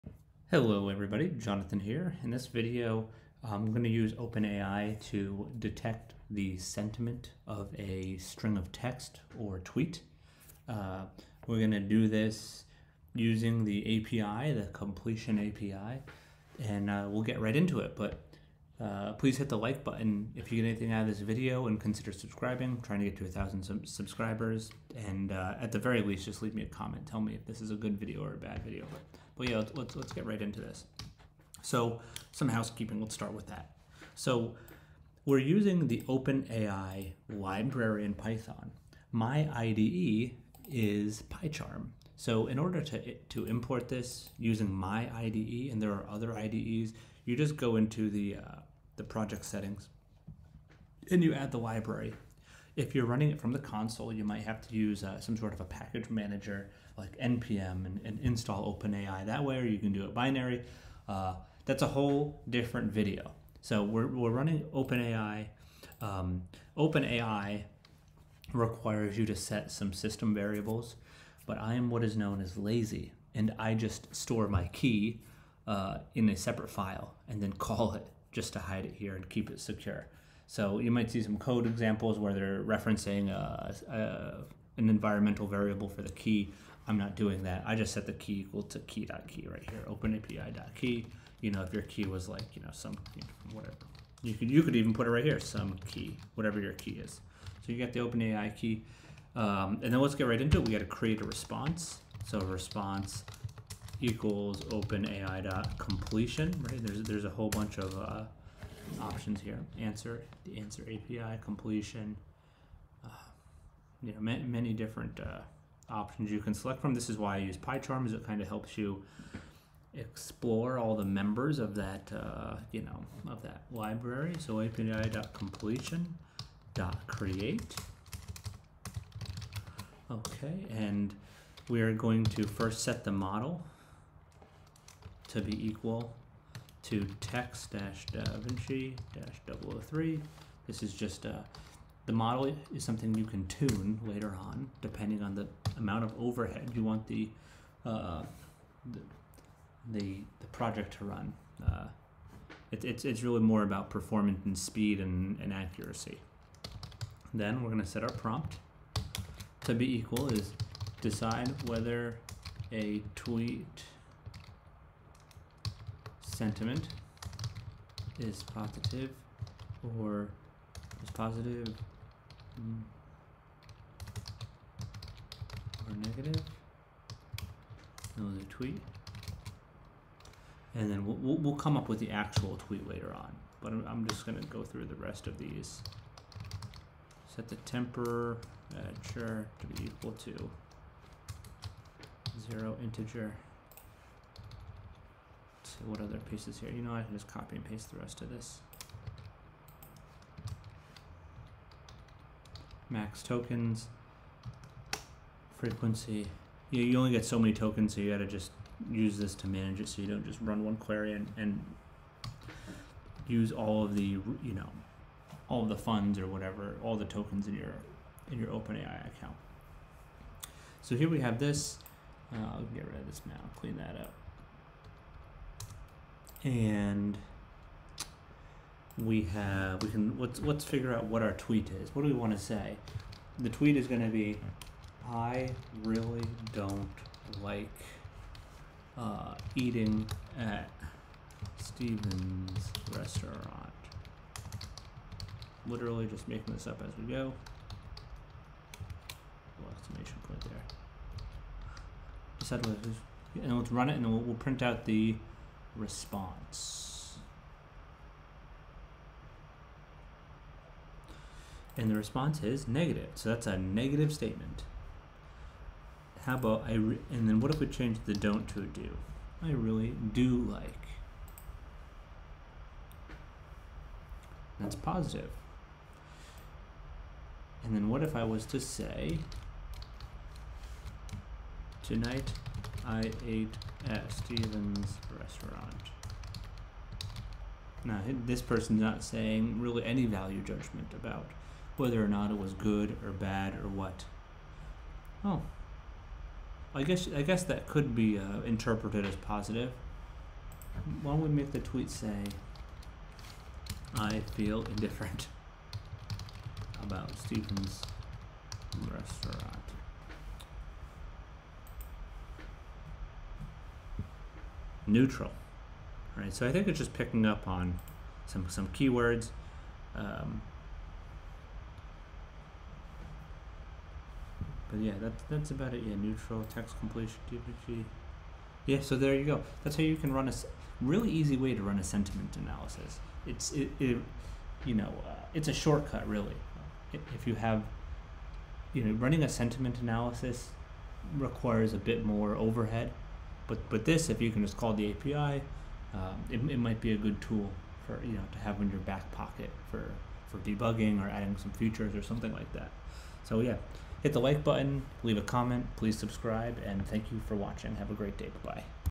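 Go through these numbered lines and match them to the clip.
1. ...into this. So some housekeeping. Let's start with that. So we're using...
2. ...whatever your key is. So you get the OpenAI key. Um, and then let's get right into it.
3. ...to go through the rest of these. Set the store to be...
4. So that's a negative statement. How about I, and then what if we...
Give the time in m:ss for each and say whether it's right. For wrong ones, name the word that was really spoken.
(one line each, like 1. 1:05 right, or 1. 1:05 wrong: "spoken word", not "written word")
1. 0:30 right
2. 1:36 right
3. 3:04 wrong: "temperature", not "store"
4. 4:23 right.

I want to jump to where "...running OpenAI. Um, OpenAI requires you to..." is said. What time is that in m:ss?
1:04.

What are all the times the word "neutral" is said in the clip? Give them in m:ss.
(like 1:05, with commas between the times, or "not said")
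5:14, 5:25.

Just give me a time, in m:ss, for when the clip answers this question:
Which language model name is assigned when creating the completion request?
2:17.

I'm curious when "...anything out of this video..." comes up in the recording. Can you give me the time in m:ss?
0:20.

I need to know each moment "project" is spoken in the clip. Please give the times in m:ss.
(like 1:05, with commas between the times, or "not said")
0:49, 2:30.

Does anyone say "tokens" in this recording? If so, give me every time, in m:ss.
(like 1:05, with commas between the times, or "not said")
3:23, 3:27, 3:37.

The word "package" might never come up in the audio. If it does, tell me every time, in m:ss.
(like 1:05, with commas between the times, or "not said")
0:55.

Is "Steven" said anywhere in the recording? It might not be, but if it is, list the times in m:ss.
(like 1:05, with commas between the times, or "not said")
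4:01, 4:44, 5:07.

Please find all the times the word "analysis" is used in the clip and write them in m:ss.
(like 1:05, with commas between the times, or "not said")
5:32, 5:39.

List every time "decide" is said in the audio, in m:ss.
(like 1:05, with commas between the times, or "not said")
2:41, 4:12.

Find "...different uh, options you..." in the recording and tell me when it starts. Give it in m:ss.
1:54.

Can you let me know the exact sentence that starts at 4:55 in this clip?
Oh, I guess I guess that could be uh, interpreted as positive.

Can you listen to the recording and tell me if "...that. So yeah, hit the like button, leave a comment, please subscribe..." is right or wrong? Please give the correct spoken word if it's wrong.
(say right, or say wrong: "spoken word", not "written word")
right.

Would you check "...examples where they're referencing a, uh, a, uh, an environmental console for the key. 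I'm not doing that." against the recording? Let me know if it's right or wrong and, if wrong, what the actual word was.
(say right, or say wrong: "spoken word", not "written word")
wrong: "variable", not "console".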